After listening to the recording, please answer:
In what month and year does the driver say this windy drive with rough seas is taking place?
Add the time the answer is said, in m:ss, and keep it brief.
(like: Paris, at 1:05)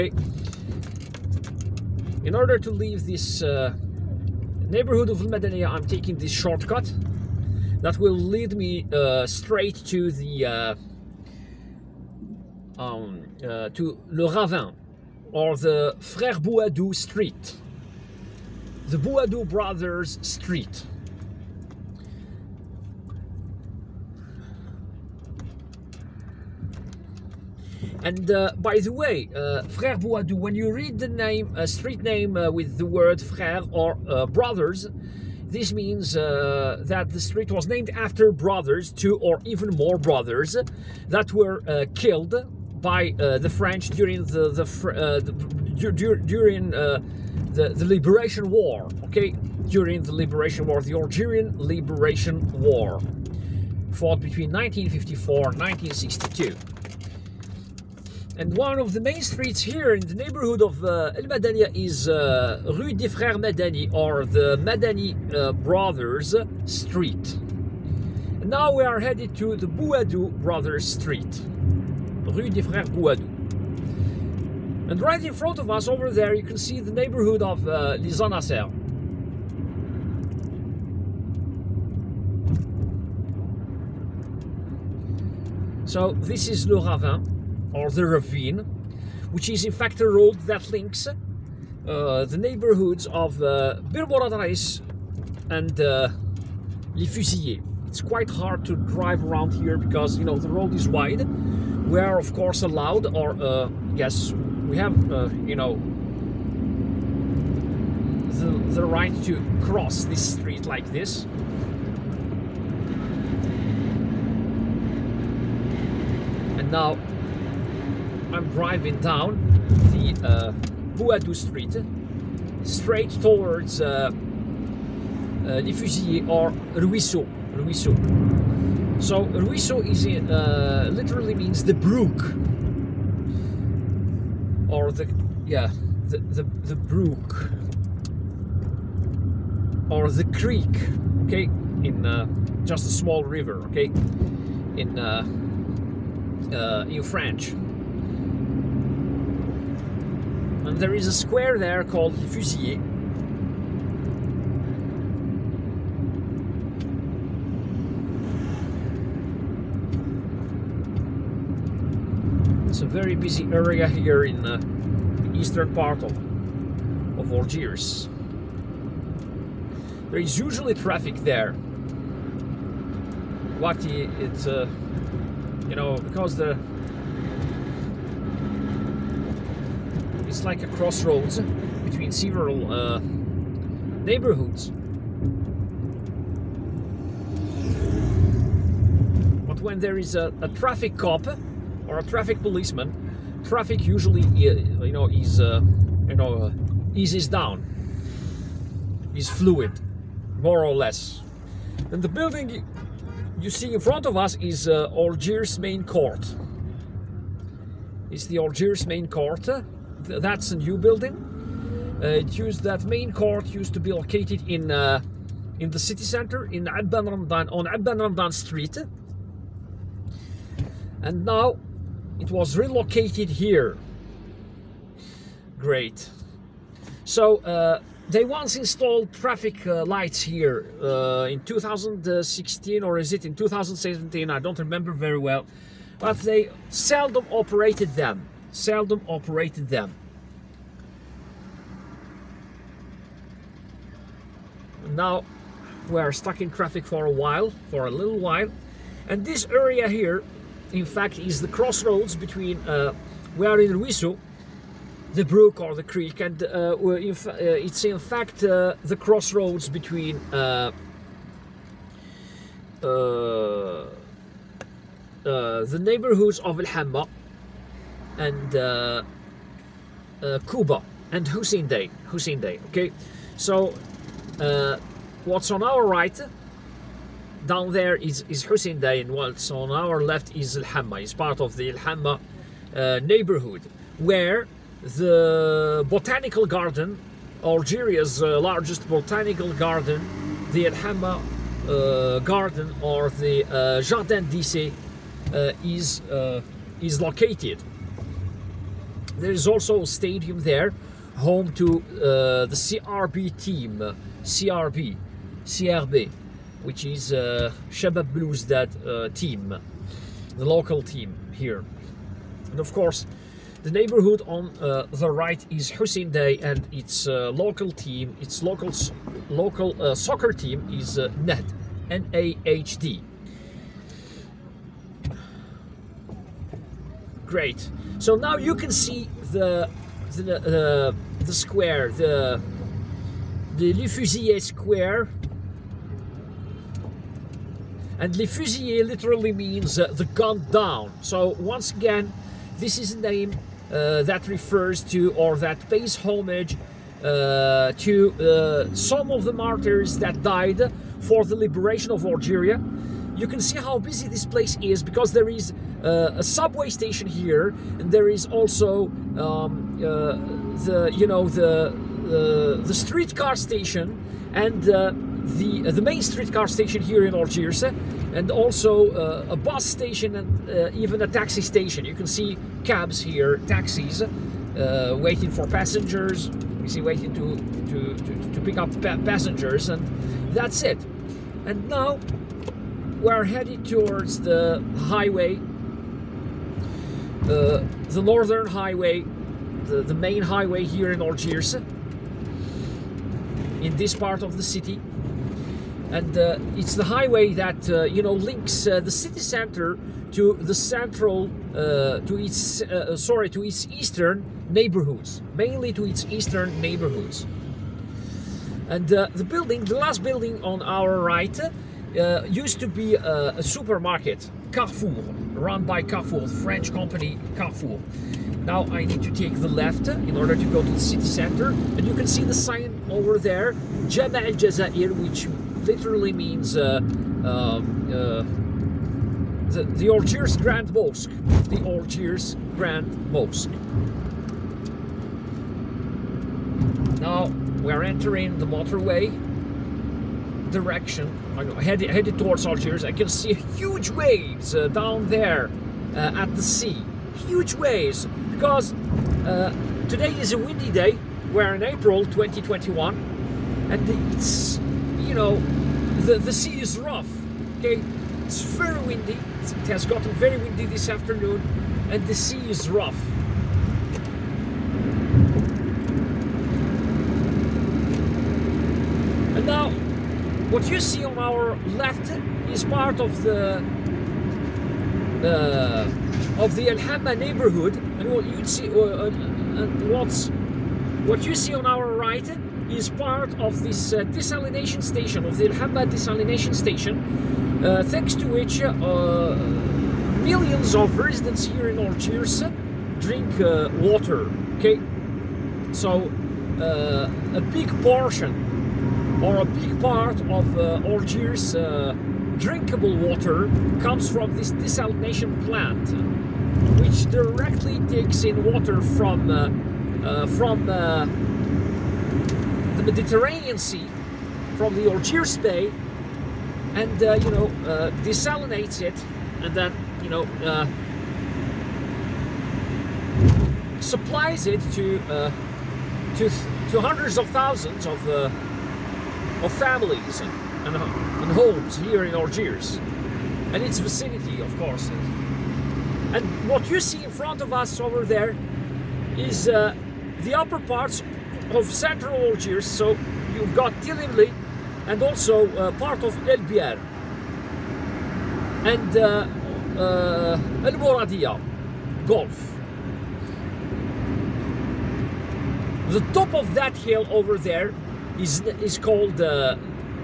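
April 2021, at 7:31.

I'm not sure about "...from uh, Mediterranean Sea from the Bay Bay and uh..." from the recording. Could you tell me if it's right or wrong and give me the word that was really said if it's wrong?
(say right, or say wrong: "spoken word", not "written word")
wrong: "Algiers", not "Bay".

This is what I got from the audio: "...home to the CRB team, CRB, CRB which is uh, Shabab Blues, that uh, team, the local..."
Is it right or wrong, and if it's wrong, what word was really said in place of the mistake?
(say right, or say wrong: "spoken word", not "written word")
right.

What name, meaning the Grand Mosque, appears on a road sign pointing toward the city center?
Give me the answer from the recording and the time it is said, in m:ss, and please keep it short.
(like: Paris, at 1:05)
Jama al Jazair, at 7:03.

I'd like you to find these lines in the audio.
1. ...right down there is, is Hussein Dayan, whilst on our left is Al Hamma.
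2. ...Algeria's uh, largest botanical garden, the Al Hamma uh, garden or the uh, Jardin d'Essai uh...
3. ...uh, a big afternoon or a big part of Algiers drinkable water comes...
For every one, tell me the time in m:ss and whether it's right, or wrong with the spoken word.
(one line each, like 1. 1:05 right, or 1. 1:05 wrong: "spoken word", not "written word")
1. 4:35 right
2. 4:47 right
3. 8:16 wrong: "portion", not "afternoon".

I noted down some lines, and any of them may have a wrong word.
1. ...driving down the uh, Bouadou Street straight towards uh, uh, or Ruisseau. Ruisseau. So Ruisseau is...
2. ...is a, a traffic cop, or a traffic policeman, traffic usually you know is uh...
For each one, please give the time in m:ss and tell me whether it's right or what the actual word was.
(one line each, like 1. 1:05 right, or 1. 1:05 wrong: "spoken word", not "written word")
1. 1:58 right
2. 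3:09 right.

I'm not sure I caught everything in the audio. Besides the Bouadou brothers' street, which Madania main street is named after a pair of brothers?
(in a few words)
Rue des Frères Madani.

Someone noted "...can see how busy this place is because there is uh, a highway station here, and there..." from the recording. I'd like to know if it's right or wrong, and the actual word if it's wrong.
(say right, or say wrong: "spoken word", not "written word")
wrong: "subway", not "highway".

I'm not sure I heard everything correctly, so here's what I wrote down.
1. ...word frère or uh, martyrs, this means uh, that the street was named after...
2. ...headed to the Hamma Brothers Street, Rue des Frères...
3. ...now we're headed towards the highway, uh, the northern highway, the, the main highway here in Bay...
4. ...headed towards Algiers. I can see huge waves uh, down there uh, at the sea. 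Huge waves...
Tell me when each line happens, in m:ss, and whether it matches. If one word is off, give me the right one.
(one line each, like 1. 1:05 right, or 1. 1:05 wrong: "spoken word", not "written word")
1. 0:32 wrong: "brothers", not "martyrs"
2. 1:08 wrong: "Bouadou", not "Hamma"
3. 6:21 wrong: "Algiers", not "Bay"
4. 7:21 right.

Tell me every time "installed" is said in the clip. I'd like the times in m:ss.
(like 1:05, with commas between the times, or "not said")
3:48.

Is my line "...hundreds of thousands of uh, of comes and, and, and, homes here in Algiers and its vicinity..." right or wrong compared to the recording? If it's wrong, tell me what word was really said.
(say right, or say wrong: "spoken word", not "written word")
wrong: "families", not "comes".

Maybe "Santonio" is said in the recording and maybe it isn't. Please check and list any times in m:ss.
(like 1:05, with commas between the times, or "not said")
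not said.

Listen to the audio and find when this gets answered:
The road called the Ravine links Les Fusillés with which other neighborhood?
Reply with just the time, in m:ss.
1:33.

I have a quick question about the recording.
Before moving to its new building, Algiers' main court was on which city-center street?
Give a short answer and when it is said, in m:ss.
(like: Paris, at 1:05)
Abban Ramdan Street, at 3:37.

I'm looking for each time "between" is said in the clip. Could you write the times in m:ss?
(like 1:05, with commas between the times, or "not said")
0:54, 3:01, 4:12, 4:19.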